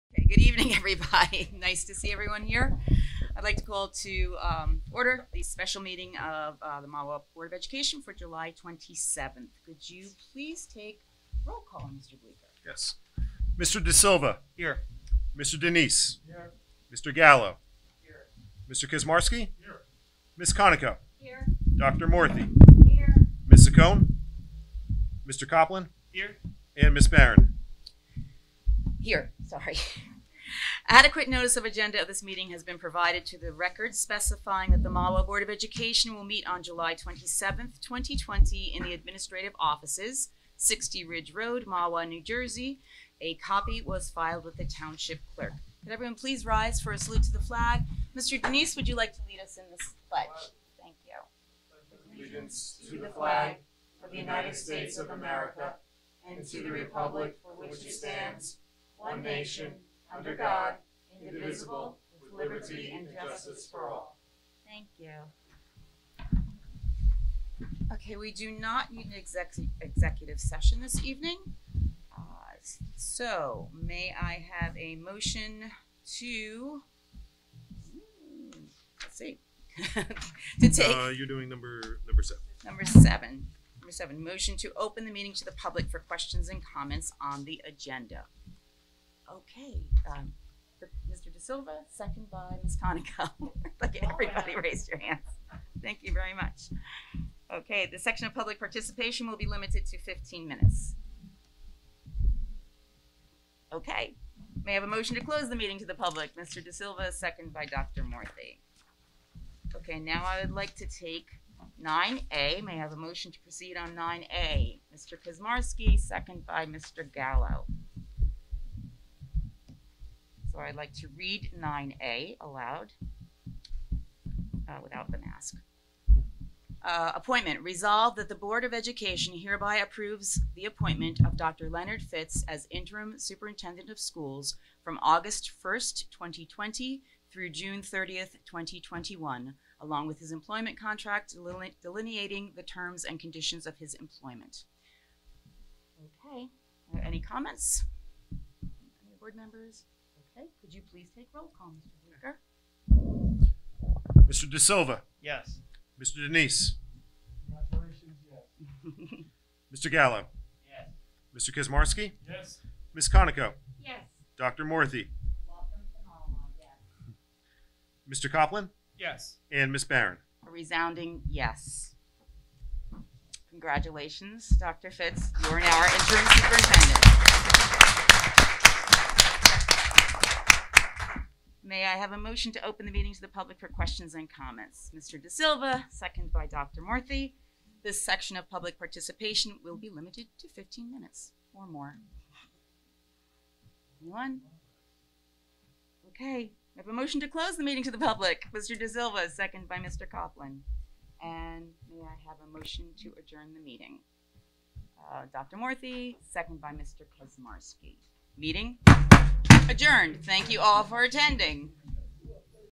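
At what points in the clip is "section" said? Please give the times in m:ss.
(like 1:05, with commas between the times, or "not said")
1:37, 3:08.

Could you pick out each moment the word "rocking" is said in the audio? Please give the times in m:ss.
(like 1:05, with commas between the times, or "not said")
not said.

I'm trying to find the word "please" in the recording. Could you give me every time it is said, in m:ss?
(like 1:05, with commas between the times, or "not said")
0:10, 0:46, 2:30.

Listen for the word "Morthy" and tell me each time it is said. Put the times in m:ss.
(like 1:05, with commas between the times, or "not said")
0:22, 1:48, 2:44, 3:06, 3:25.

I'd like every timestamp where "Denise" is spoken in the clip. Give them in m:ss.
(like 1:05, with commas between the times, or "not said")
0:15, 0:48, 2:36.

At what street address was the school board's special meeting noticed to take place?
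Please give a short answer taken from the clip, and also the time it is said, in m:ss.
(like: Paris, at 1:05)
60 Ridge Road, at 0:40.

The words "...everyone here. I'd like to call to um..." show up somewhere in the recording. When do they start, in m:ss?
0:02.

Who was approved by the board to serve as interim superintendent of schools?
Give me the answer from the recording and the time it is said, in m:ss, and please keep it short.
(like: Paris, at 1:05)
Dr. Leonard Fitz, at 2:11.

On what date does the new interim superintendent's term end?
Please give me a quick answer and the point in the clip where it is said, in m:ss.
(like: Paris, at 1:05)
June 30th, 2021, at 2:17.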